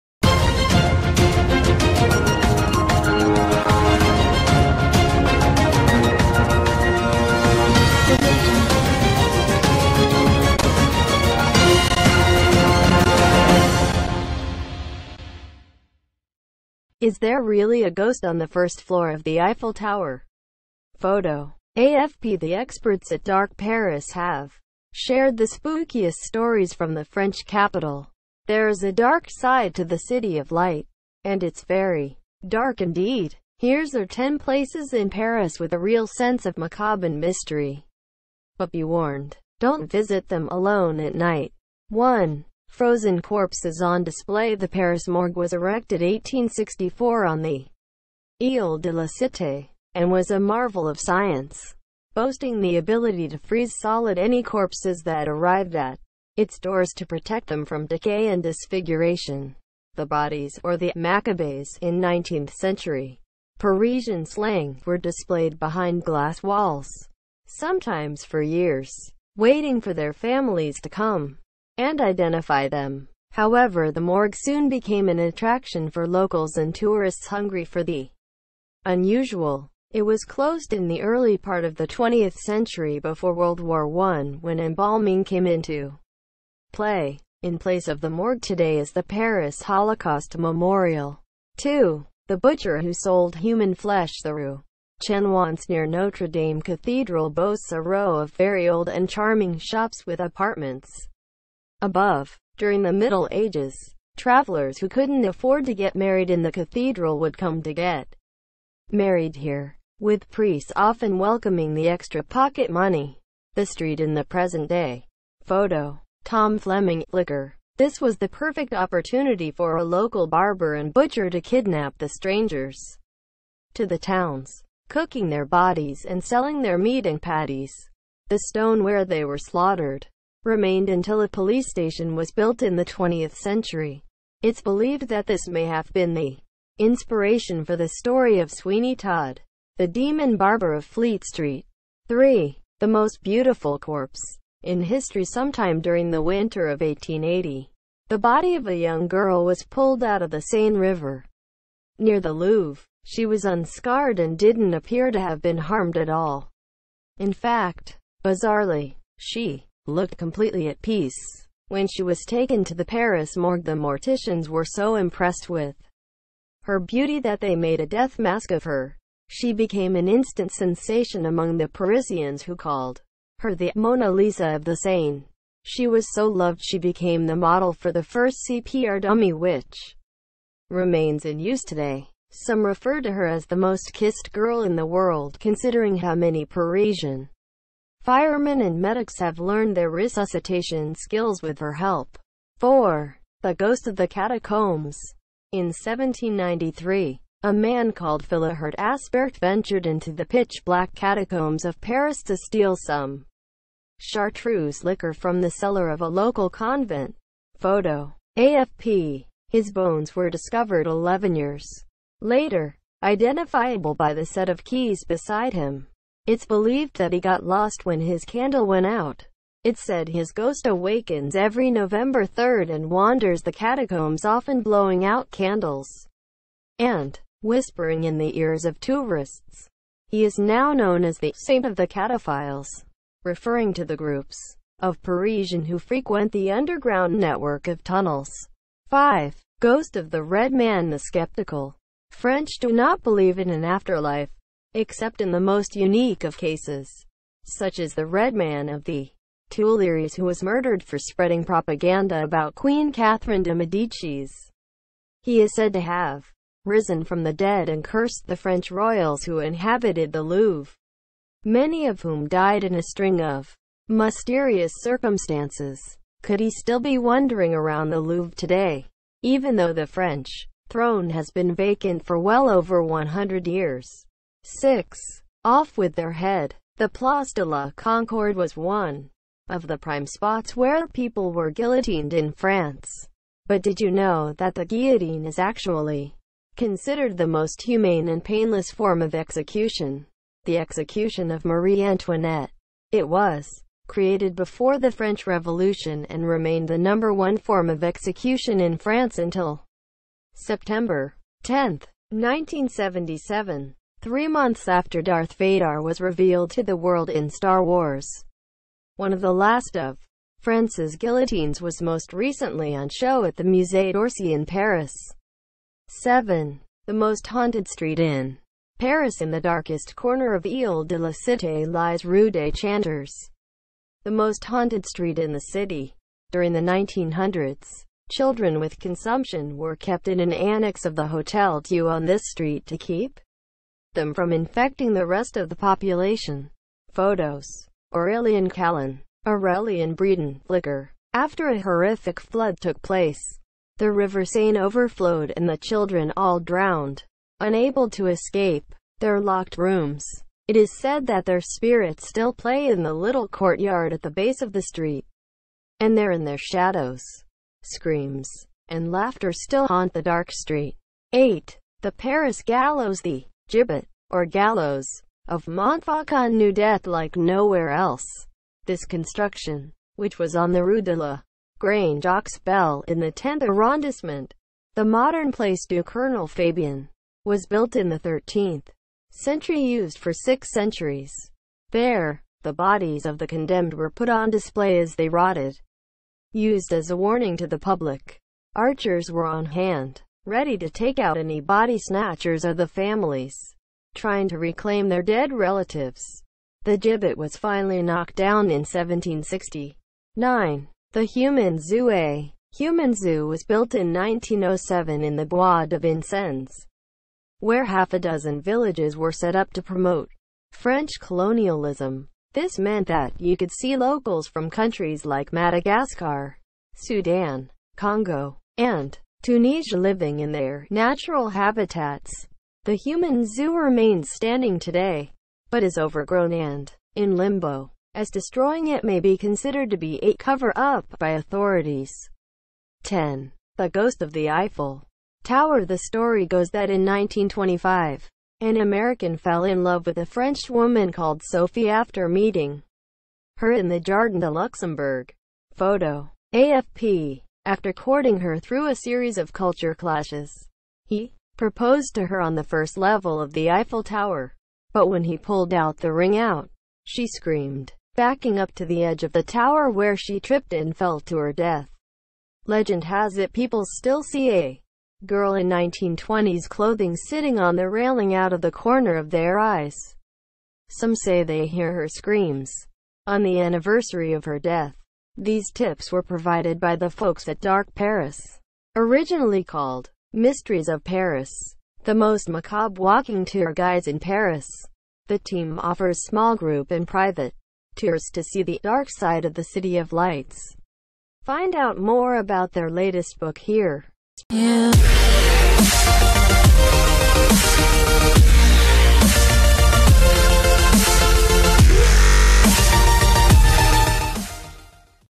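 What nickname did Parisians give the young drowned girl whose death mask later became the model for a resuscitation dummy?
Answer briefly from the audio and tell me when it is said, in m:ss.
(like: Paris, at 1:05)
Mona Lisa of the Seine, at 2:53.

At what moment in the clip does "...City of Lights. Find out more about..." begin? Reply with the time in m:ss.
8:09.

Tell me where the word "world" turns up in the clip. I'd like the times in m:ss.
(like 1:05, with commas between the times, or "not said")
1:23, 3:04, 5:06.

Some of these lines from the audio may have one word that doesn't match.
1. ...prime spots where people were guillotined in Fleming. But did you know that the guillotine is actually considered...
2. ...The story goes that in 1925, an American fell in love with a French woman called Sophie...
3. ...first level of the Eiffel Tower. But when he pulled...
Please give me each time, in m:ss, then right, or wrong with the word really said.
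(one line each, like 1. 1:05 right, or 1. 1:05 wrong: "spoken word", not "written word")
1. 4:39 wrong: "France", not "Fleming"
2. 7:15 right
3. 7:32 right.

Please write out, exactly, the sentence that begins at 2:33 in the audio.
She was unscarred and didn't appear to have been harmed at all.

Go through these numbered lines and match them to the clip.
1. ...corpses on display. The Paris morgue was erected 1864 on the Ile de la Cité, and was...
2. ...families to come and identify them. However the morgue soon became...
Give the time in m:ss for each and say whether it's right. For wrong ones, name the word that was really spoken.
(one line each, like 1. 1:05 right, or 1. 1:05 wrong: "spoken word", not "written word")
1. 0:43 right
2. 1:10 right.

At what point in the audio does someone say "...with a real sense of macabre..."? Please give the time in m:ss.
0:35.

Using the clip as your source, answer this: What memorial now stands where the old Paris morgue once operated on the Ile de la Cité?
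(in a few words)
Paris Holocaust Memorial.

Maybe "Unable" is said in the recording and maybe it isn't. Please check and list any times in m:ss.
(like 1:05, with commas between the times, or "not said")
5:47.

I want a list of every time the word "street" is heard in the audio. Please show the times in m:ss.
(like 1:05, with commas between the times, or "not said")
1:53, 2:21, 5:17, 5:24, 5:32, 5:54, 6:00.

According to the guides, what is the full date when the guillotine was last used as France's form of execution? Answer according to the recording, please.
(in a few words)
September 10, 1977.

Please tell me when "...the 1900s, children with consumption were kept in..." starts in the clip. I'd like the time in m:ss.
5:26.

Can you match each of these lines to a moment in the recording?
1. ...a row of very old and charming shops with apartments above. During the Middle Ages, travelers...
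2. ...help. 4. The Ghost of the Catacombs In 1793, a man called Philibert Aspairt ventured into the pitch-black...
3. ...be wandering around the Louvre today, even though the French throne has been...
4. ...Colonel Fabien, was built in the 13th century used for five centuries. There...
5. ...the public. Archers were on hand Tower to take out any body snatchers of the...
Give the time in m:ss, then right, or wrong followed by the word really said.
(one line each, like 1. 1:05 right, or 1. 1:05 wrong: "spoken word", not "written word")
1. 1:37 right
2. 3:11 right
3. 4:26 right
4. 6:15 wrong: "six", not "five"
5. 6:27 wrong: "Ready", not "Tower".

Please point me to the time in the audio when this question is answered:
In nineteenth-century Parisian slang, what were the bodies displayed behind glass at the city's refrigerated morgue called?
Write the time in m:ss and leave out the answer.
1:00.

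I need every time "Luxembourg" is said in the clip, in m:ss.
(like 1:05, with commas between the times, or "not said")
7:24.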